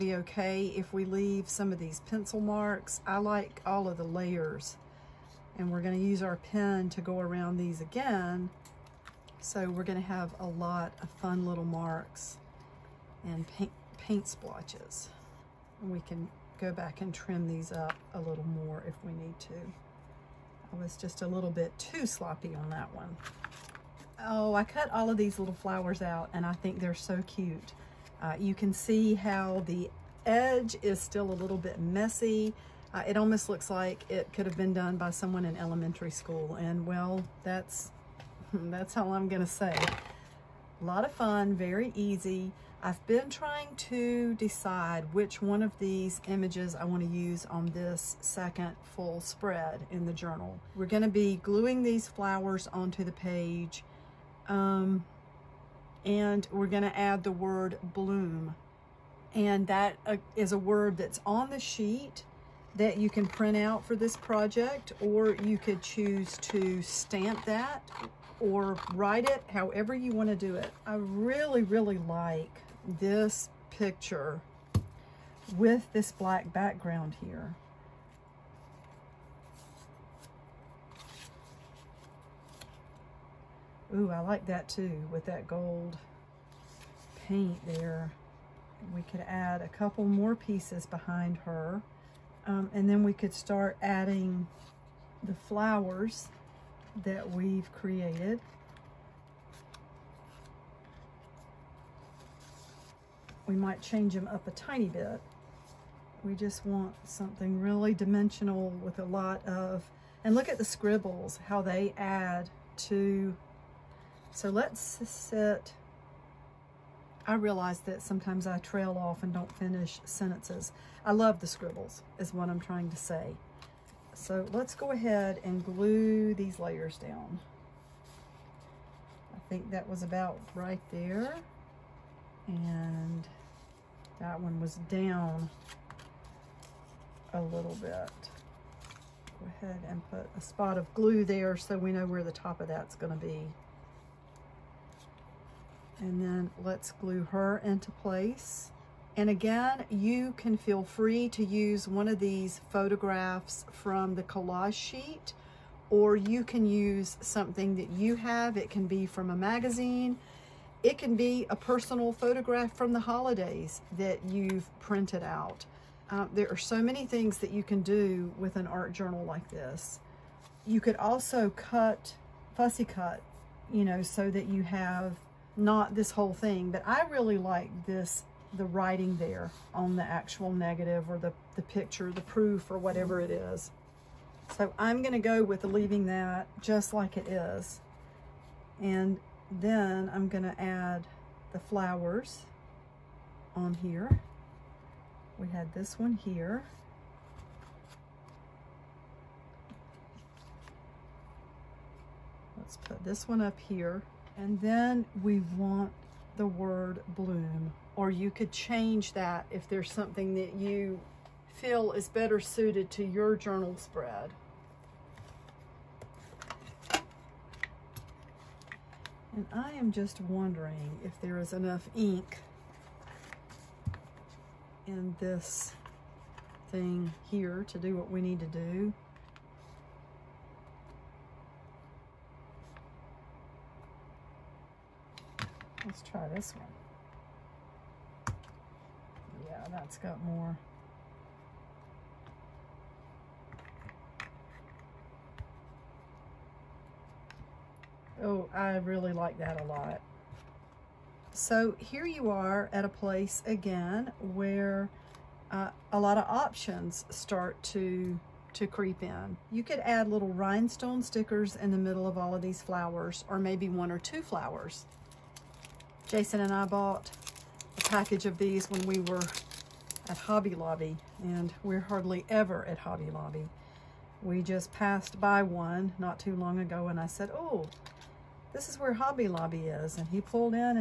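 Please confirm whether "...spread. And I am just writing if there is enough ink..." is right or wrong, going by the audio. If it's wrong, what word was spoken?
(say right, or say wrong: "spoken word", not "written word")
wrong: "wondering", not "writing".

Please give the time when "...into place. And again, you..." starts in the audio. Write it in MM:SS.
02:27.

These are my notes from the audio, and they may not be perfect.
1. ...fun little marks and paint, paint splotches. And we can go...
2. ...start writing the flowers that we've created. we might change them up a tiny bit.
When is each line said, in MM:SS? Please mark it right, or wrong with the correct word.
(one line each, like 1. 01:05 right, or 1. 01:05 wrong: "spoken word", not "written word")
1. 00:11 right
2. 01:33 wrong: "adding", not "writing".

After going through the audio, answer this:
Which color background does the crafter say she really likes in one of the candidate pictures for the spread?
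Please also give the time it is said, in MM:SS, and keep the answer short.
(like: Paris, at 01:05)
black, at 01:16.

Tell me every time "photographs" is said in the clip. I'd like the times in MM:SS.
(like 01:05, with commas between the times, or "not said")
02:32, 02:42.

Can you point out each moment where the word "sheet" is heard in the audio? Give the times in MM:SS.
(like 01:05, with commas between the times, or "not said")
01:01, 02:34.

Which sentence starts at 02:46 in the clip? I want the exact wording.
Uh, there are so many things that you can do with an art journal like this.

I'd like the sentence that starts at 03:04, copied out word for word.
So I'm gonna go with leaving that just like it is.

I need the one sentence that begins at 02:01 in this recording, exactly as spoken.
I love the scribbles is what I'm trying to say.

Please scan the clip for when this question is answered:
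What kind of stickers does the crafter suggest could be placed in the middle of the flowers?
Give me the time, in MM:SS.
04:20.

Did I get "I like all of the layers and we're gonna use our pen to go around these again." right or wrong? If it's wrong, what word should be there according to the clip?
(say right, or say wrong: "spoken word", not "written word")
right.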